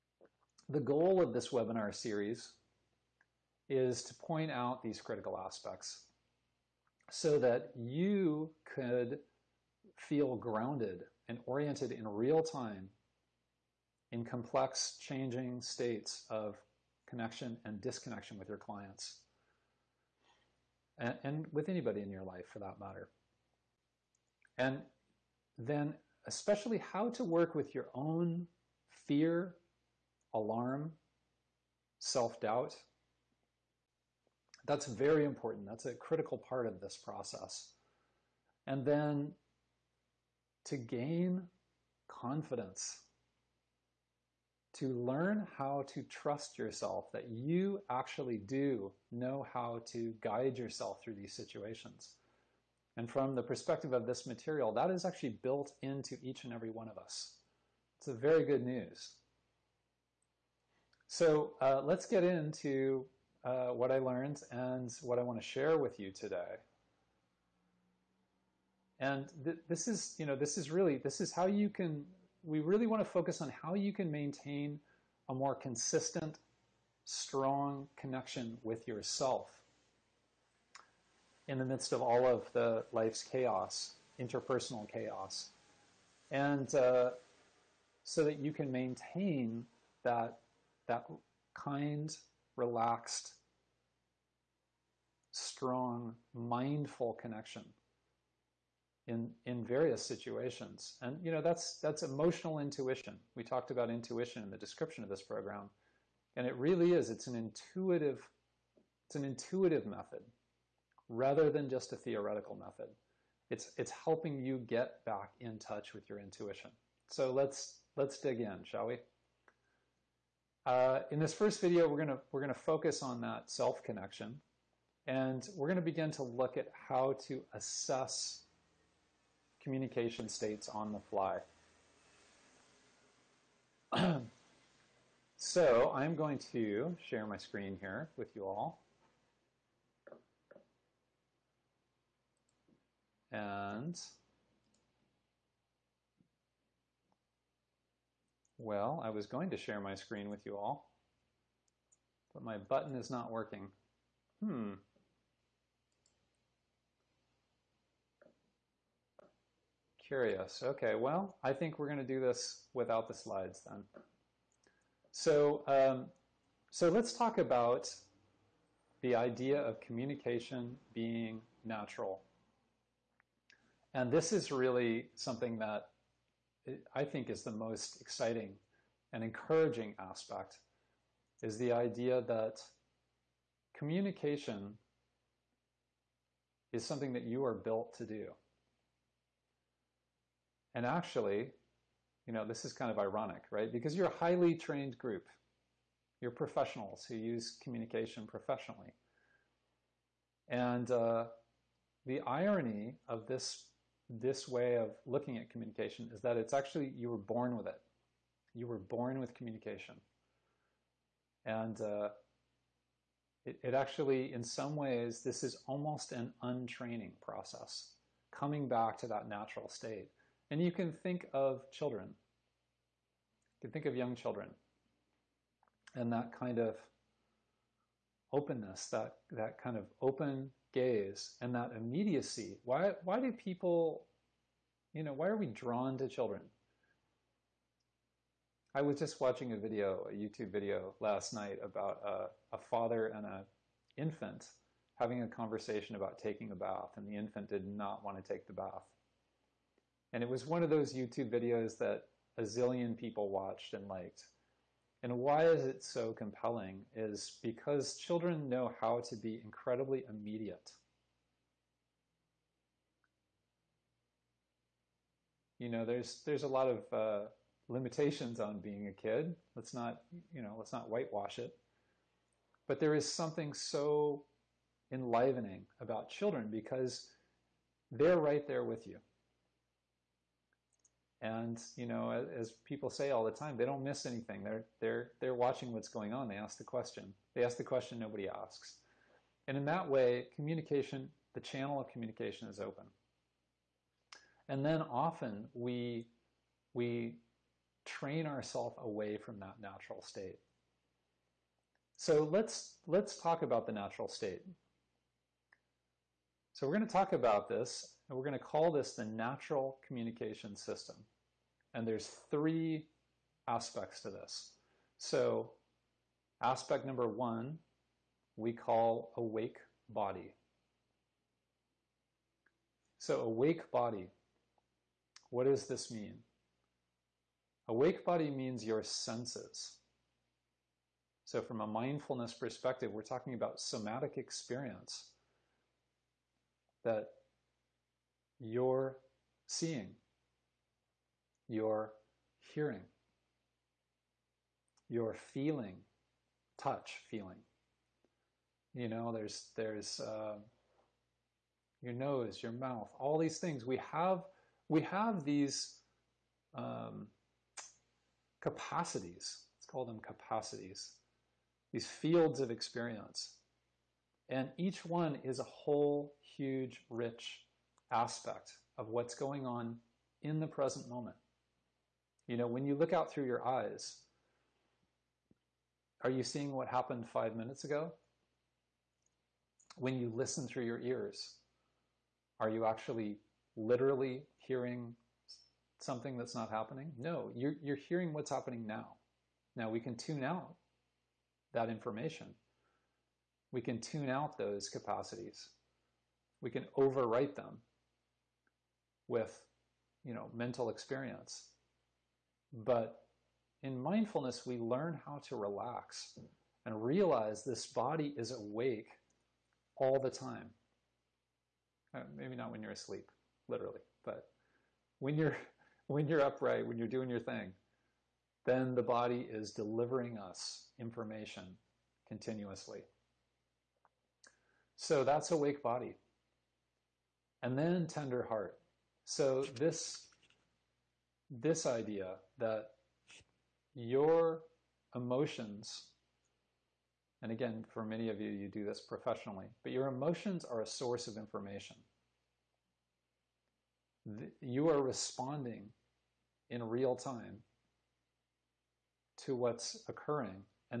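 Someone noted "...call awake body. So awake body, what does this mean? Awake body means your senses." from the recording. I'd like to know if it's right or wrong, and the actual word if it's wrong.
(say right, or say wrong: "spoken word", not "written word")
right.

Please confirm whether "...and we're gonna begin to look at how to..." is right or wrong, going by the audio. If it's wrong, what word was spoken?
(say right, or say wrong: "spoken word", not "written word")
right.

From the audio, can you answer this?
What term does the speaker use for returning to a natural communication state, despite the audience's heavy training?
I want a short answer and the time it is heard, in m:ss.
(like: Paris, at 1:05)
untraining process, at 3:36.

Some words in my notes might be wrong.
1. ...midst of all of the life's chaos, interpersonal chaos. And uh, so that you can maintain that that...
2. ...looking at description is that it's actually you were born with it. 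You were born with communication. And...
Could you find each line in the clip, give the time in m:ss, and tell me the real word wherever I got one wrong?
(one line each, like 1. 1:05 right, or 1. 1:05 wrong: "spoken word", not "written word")
1. 1:21 right
2. 3:25 wrong: "communication", not "description".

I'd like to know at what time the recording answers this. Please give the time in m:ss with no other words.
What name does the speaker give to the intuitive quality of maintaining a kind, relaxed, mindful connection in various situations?
1:42.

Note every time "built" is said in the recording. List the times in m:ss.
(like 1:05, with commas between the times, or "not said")
0:55, 3:07.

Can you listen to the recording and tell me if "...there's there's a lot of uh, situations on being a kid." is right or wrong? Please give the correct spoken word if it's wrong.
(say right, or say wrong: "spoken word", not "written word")
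wrong: "limitations", not "situations".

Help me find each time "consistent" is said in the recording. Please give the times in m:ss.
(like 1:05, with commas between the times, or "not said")
1:15.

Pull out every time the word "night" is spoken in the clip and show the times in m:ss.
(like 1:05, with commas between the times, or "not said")
4:01.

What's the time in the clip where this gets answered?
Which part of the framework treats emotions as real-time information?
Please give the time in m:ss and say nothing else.
7:07.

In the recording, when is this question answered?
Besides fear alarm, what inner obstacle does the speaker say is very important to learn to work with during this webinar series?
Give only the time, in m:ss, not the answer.
0:31.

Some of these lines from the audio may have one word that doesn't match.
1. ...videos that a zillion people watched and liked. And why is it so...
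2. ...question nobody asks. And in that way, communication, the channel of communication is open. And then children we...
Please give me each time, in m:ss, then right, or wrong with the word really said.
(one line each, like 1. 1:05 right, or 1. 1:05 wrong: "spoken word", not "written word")
1. 4:11 right
2. 4:47 wrong: "often", not "children".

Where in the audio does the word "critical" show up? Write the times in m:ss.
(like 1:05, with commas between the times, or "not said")
0:05, 0:35.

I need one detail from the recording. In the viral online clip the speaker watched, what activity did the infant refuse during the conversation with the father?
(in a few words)
taking a bath.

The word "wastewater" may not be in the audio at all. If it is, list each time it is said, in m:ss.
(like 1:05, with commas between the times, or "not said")
not said.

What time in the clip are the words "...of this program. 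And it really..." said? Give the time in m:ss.
1:45.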